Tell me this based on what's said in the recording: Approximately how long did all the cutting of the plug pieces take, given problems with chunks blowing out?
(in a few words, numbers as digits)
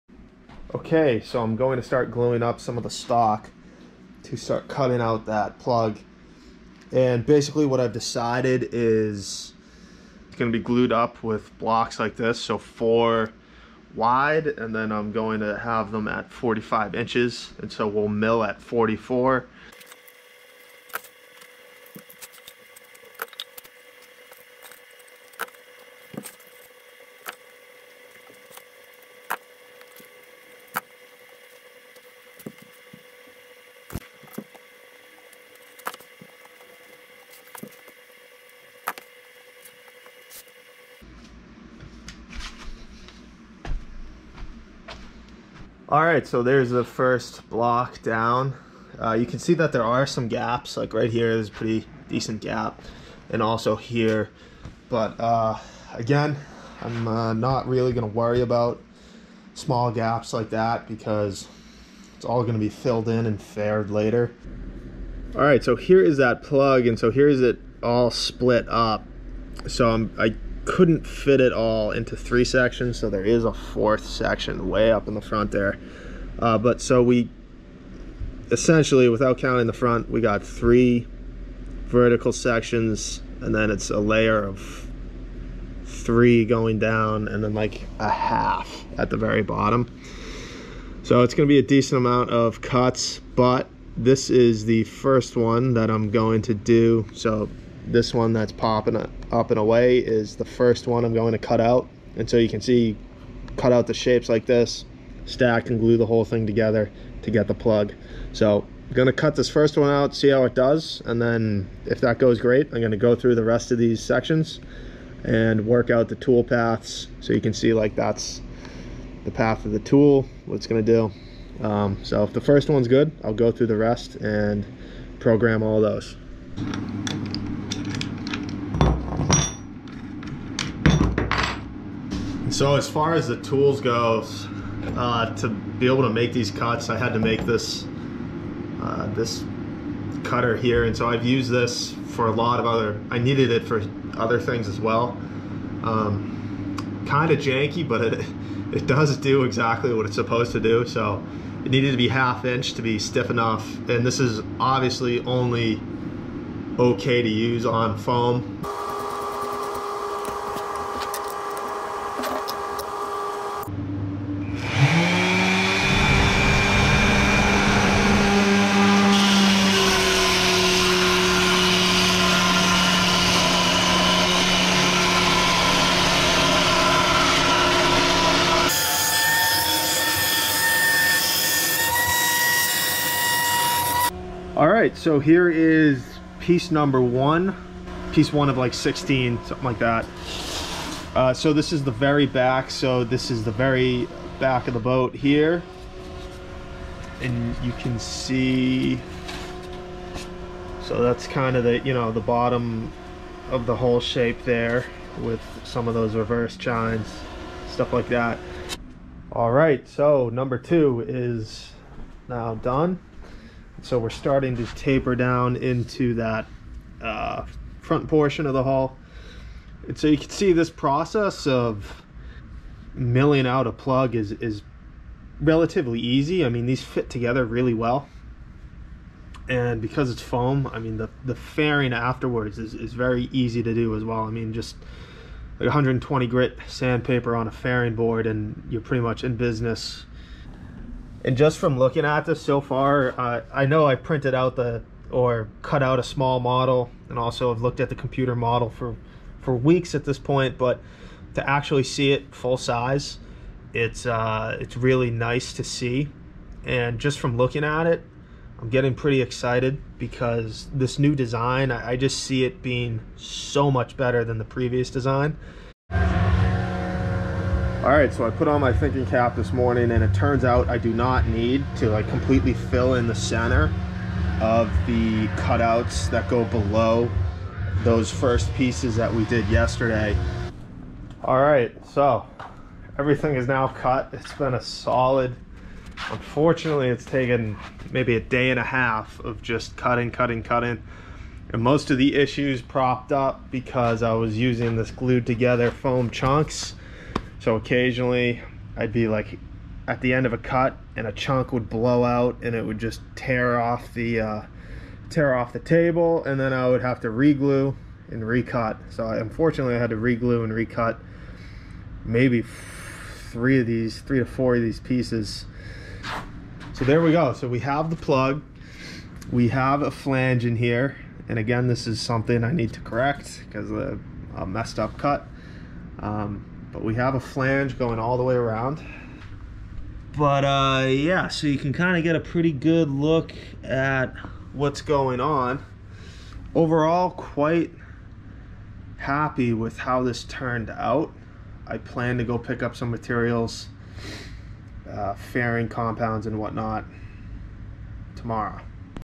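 a day and a half.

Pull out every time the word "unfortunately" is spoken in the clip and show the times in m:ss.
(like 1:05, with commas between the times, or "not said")
4:46, 5:09.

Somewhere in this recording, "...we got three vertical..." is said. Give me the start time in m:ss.
1:20.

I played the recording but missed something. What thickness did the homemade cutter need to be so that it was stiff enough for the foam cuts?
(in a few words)
1/2 inch.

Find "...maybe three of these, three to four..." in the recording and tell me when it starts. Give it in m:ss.
5:12.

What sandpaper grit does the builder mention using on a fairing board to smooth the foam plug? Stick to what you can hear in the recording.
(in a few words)
120.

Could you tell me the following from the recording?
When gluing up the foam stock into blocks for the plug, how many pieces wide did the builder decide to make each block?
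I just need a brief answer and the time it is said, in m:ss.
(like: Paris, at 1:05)
4, at 0:12.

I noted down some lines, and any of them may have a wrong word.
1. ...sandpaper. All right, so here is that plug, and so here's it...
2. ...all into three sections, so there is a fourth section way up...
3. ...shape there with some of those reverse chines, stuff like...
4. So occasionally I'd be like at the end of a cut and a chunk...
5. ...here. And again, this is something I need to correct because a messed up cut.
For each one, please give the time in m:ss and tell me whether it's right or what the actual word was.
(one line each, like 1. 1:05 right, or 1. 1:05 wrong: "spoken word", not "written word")
1. 1:03 wrong: "later", not "sandpaper"
2. 1:11 right
3. 3:23 right
4. 4:57 right
5. 5:20 right.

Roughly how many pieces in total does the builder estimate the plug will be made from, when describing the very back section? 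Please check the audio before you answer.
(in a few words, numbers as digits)
16.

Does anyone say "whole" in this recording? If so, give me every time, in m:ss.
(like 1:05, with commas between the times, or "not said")
1:46, 3:23.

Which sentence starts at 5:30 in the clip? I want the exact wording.
But uh, yeah, so you can kind of get a pretty good look at what's going on.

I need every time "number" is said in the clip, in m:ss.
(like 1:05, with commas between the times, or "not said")
3:06, 3:30.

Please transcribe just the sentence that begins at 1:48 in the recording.
So I'm gonna cut this first one out, see how it does.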